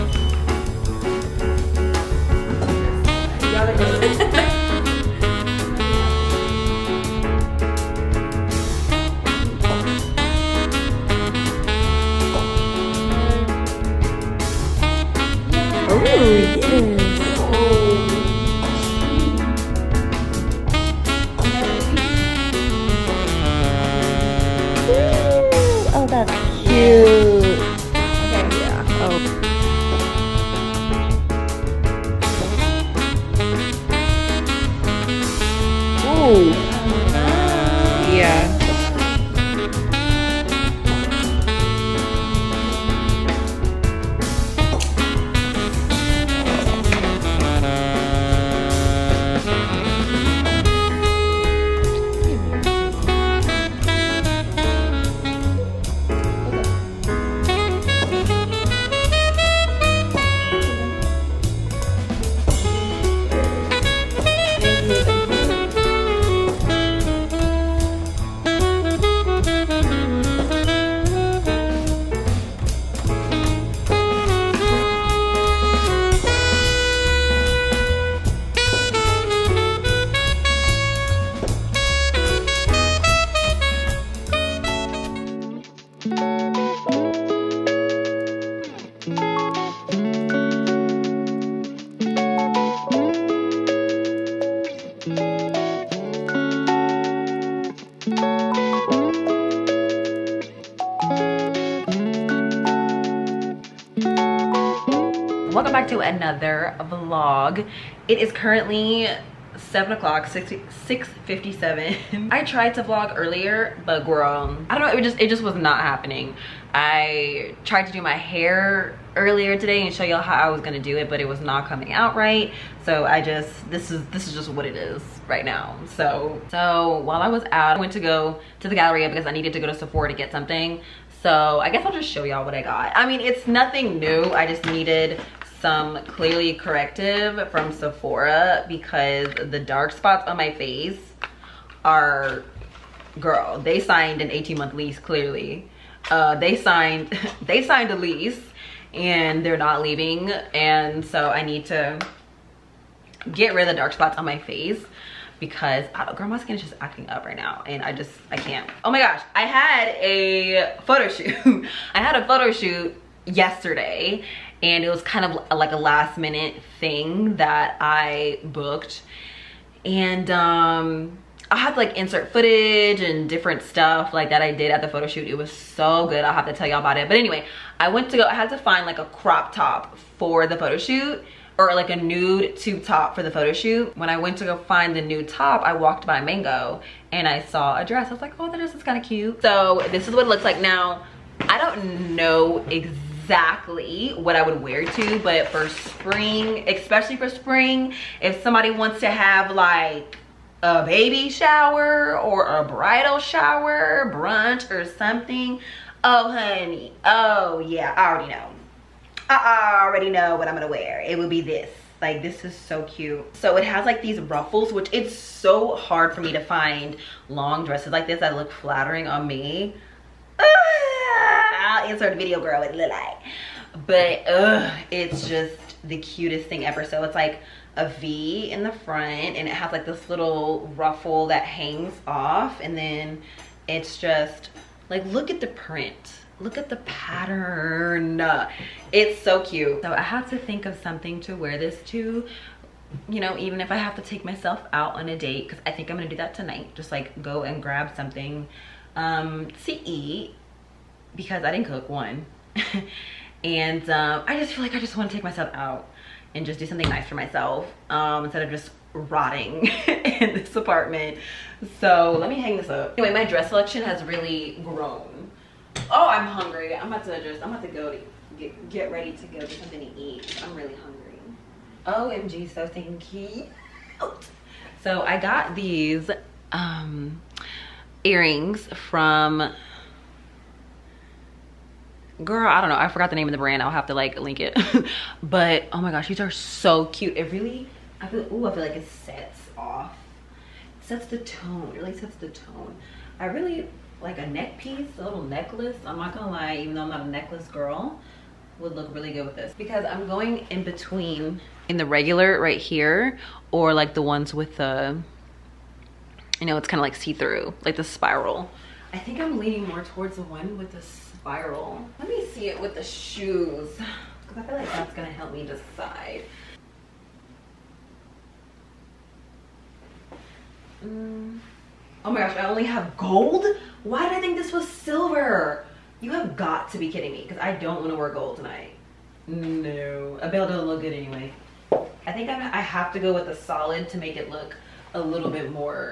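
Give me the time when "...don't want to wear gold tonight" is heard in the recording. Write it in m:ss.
5:27.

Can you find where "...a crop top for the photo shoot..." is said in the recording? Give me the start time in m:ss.
2:58.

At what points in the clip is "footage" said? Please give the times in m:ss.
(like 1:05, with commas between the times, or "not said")
2:52.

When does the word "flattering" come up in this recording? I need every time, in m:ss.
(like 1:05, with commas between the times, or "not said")
3:38.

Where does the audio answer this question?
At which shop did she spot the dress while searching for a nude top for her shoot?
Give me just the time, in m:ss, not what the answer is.
3:06.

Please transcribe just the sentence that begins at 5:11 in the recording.
Let me see it with the shoes, because I feel like that's gonna help me decide.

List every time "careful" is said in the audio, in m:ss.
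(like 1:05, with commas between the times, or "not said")
not said.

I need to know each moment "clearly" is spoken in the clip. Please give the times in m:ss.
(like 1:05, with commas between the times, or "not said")
2:16, 2:24.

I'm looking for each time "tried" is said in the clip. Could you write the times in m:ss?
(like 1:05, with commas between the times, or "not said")
1:52, 1:57.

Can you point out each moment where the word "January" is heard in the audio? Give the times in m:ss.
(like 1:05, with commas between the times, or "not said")
not said.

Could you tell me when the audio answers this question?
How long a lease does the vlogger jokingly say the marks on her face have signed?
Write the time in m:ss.
2:24.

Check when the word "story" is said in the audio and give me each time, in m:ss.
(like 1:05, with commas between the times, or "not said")
not said.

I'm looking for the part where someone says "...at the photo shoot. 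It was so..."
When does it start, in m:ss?
2:54.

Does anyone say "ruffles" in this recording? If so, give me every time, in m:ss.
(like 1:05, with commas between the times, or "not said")
3:34, 3:50.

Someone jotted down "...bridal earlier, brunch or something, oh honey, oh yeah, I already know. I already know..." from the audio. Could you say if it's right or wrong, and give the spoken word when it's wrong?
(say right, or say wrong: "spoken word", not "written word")
wrong: "shower", not "earlier".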